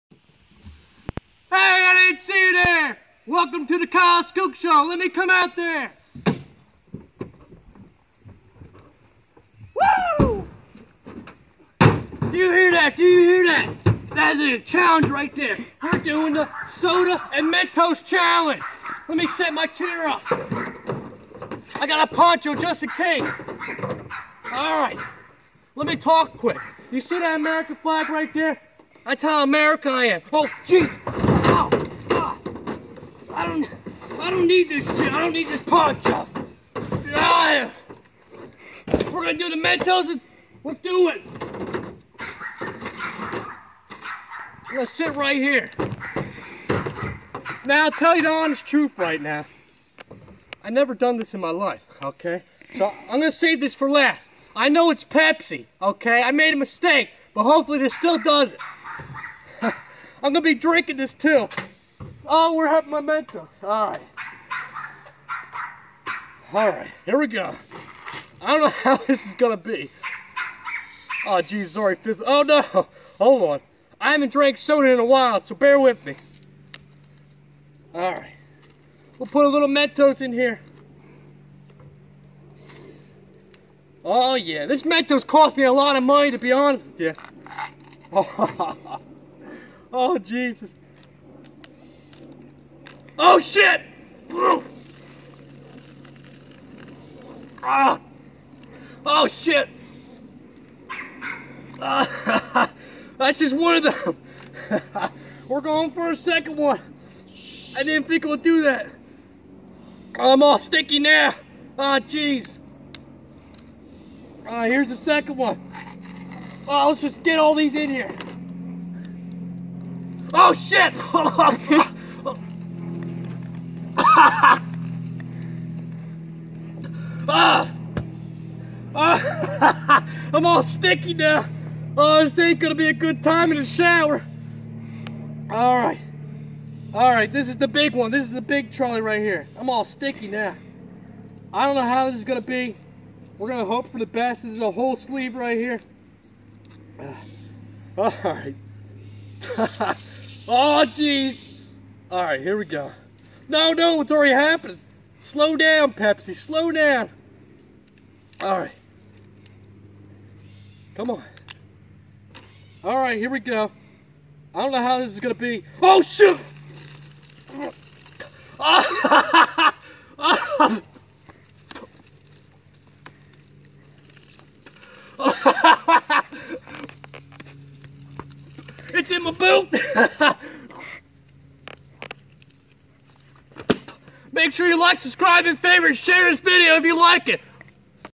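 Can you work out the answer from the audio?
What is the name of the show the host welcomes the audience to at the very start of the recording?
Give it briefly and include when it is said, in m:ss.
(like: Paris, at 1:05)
Kyle Skook Show, at 0:03.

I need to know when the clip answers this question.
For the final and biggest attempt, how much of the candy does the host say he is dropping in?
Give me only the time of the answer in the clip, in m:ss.
2:24.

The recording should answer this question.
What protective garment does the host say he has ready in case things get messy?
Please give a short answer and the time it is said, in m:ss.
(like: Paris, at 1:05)
Poncho, at 0:22.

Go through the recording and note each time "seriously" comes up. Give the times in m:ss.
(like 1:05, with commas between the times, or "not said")
not said.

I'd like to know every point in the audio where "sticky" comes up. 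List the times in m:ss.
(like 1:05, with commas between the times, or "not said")
1:50, 2:10, 2:19.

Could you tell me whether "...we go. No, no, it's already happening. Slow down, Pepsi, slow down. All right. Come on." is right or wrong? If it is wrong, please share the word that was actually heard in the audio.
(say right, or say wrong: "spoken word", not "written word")
right.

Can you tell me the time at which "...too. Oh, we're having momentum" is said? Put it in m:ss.
1:01.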